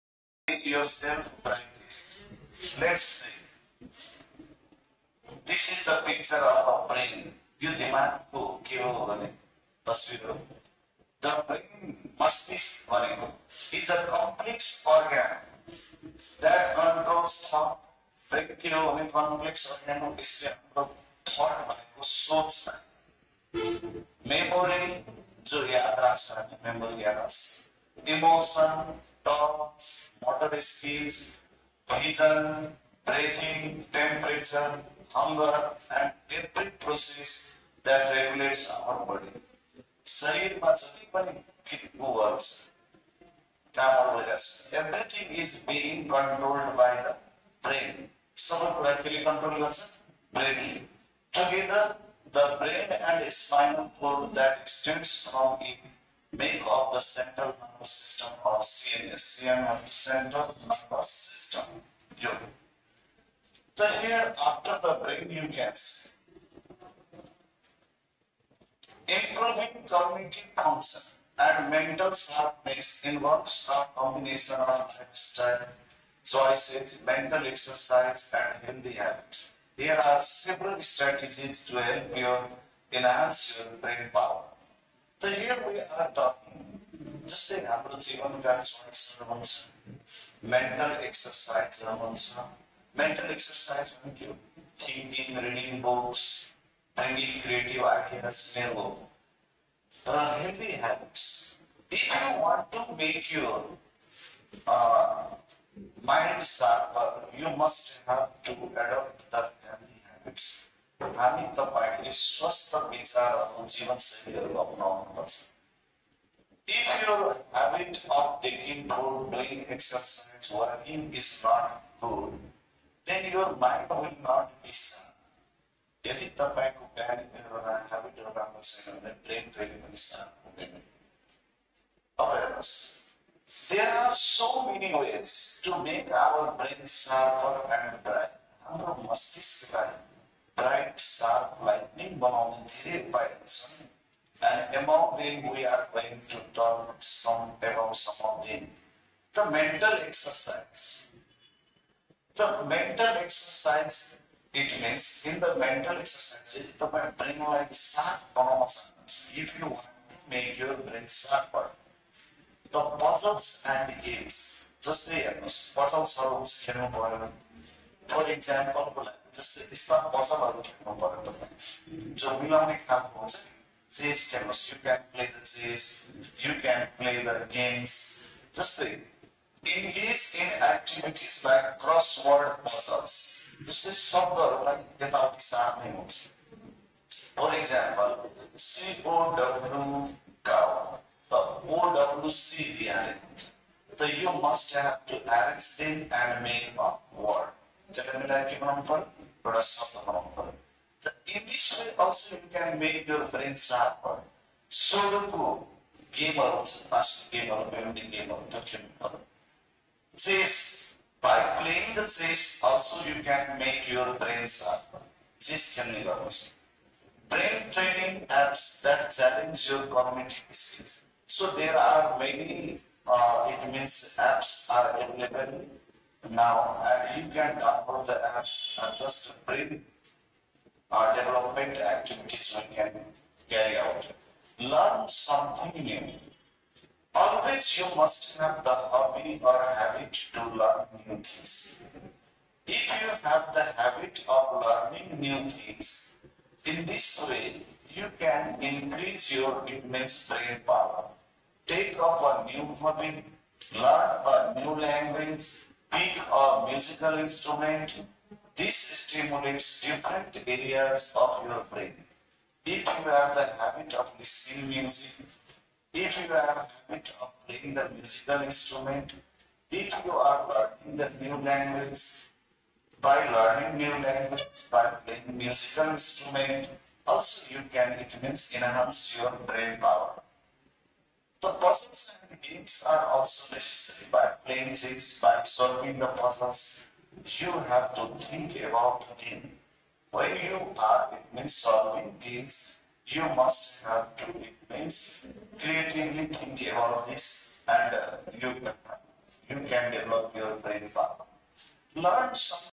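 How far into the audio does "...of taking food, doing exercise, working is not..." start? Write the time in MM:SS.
01:58.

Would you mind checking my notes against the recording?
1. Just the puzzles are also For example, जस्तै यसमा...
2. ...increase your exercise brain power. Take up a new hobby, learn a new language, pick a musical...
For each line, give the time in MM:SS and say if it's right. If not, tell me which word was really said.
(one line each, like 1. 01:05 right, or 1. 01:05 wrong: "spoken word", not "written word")
1. 02:44 right
2. 04:08 wrong: "immense", not "exercise".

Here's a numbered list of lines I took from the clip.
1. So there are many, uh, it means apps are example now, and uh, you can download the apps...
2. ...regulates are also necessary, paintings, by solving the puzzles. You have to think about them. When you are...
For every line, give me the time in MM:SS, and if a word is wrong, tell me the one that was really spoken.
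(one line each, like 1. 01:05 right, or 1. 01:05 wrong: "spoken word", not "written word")
1. 03:41 wrong: "available", not "example"
2. 04:42 wrong: "games", not "regulates".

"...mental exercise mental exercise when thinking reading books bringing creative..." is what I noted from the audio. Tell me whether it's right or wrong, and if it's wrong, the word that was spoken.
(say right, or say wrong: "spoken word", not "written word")
right.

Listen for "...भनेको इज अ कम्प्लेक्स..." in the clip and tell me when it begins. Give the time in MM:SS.
00:12.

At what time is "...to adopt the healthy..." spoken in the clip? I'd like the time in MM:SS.
01:48.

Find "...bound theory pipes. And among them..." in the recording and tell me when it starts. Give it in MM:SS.
02:22.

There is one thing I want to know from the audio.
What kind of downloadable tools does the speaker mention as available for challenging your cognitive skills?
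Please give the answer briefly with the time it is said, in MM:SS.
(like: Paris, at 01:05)
Brain training apps, at 03:37.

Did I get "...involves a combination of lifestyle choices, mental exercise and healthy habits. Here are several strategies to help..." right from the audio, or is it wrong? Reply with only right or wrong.
right.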